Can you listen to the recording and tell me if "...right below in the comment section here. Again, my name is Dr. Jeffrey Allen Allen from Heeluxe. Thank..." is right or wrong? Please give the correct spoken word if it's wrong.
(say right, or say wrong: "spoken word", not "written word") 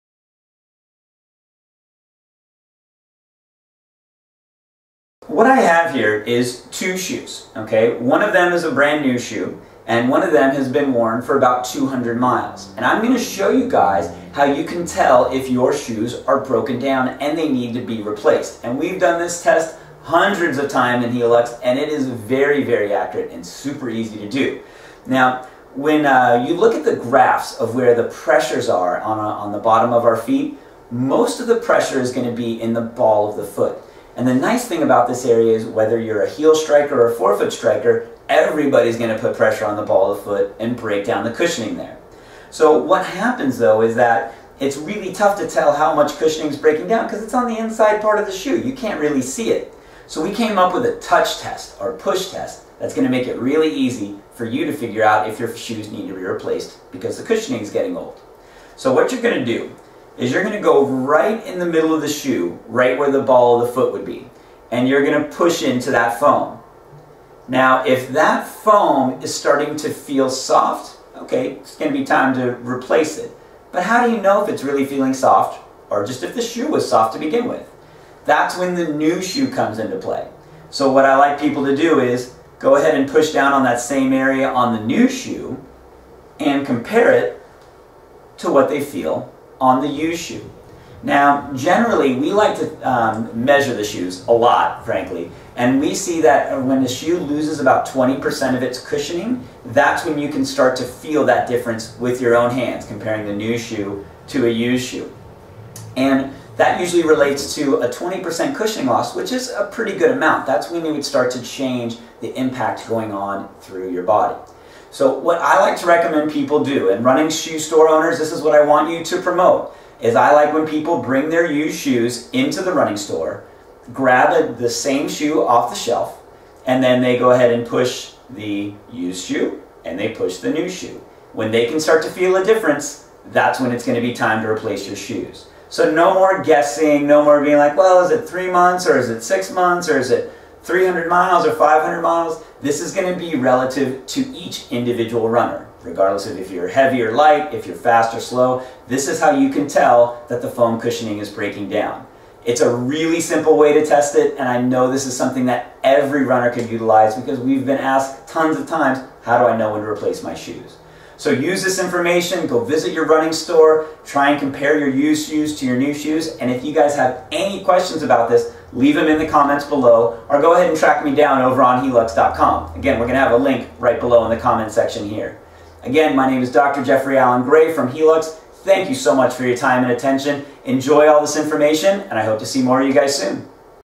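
wrong: "Gray", not "Allen".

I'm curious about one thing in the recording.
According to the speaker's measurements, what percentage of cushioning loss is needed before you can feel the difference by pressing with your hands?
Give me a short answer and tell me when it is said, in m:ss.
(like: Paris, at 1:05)
20%, at 1:37.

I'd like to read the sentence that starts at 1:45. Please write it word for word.
And that usually relates to a 20% cushioning loss, which is a pretty good amount.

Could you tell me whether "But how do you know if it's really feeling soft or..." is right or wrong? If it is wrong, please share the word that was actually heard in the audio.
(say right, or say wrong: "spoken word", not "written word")
right.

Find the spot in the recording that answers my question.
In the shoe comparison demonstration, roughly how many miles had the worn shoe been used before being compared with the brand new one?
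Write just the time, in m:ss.
0:11.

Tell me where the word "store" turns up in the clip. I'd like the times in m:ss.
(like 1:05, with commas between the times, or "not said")
1:57, 2:02, 2:43.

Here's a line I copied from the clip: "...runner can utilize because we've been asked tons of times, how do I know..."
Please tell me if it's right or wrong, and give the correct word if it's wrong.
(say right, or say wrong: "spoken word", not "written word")
right.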